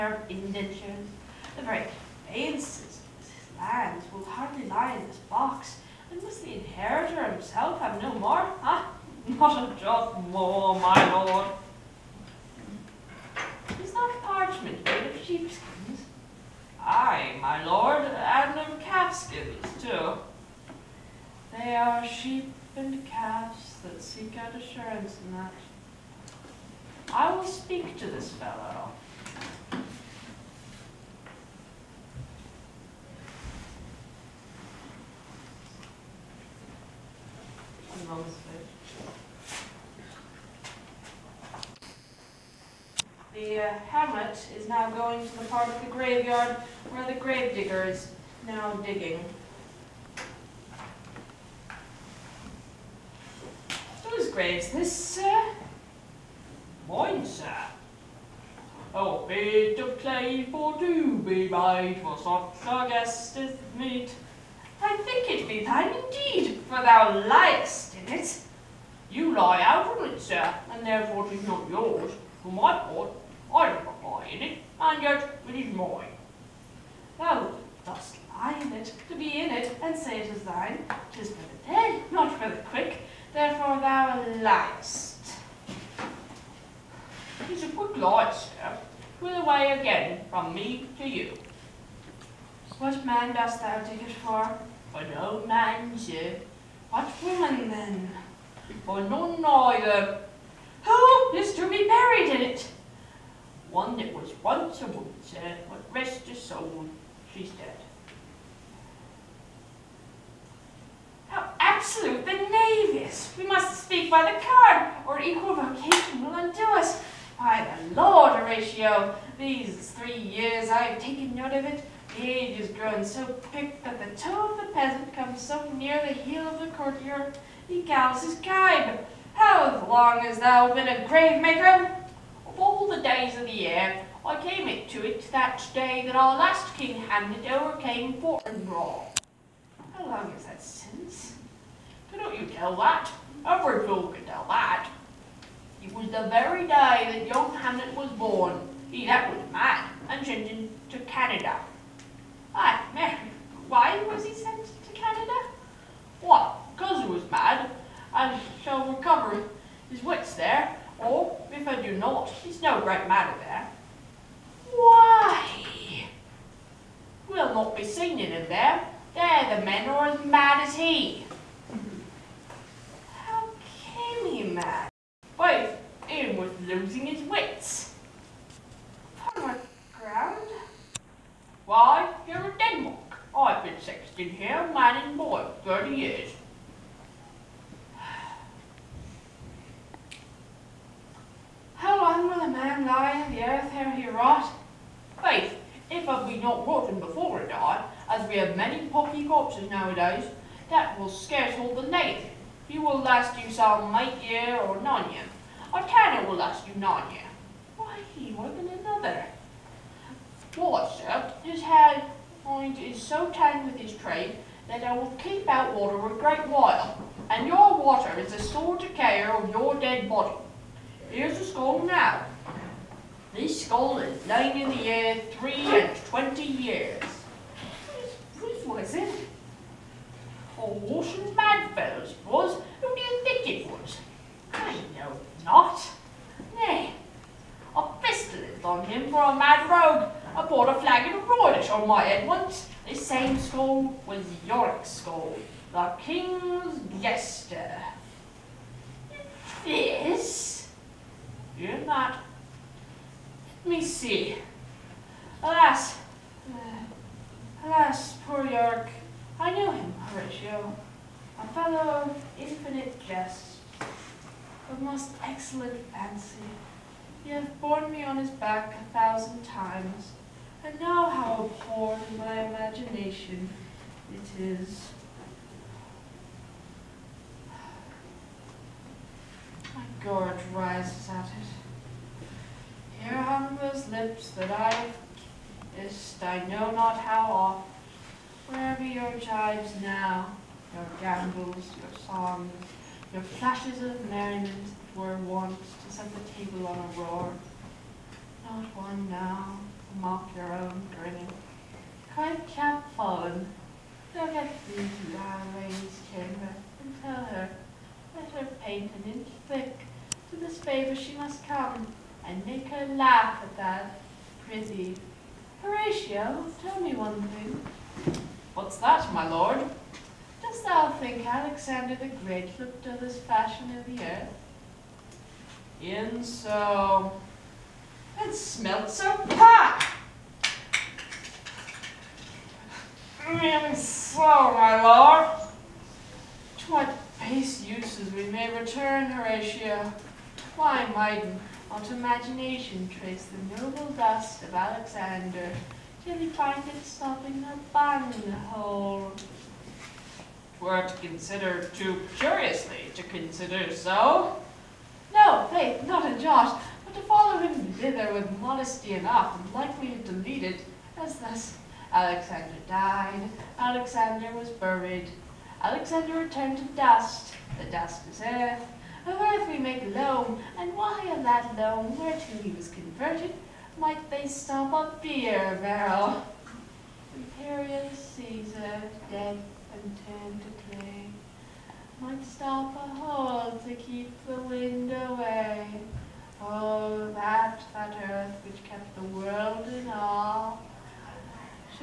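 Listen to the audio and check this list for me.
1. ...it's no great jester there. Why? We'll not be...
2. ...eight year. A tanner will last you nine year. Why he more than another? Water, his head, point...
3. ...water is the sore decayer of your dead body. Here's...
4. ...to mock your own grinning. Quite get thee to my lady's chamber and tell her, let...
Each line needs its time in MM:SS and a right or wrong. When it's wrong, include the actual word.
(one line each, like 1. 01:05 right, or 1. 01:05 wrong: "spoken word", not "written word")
1. 02:42 wrong: "matter", not "jester"
2. 03:24 wrong: "nine", not "eight"
3. 03:37 right
4. 04:59 right.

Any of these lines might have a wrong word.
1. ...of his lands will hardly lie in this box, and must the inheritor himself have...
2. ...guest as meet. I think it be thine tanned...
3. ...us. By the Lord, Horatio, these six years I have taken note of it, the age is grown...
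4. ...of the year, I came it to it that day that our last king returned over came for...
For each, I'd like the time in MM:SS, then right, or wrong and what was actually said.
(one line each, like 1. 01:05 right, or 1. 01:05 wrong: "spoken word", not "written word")
1. 00:02 right
2. 01:02 wrong: "indeed", not "tanned"
3. 01:56 wrong: "three", not "six"
4. 02:13 wrong: "handed", not "returned".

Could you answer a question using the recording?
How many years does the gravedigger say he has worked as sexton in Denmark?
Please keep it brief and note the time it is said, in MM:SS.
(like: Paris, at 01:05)
30, at 03:05.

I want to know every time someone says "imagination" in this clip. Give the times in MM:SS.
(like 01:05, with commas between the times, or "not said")
04:32, 05:41.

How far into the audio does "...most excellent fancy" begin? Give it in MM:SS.
04:24.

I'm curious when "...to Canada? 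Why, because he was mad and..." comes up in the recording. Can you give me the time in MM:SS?
02:34.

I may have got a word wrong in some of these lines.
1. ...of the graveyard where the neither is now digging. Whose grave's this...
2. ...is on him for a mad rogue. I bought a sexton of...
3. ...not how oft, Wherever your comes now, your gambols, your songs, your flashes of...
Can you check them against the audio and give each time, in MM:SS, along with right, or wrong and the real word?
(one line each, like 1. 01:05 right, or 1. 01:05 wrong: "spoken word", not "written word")
1. 00:45 wrong: "gravedigger", not "neither"
2. 03:58 wrong: "flagon", not "sexton"
3. 04:46 wrong: "jibes", not "comes".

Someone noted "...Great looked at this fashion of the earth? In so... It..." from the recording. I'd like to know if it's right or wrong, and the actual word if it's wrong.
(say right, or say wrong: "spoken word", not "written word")
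right.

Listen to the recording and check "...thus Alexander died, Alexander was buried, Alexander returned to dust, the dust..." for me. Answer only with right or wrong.
right.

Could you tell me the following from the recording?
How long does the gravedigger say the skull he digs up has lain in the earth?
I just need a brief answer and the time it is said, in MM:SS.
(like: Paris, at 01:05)
23 years, at 03:45.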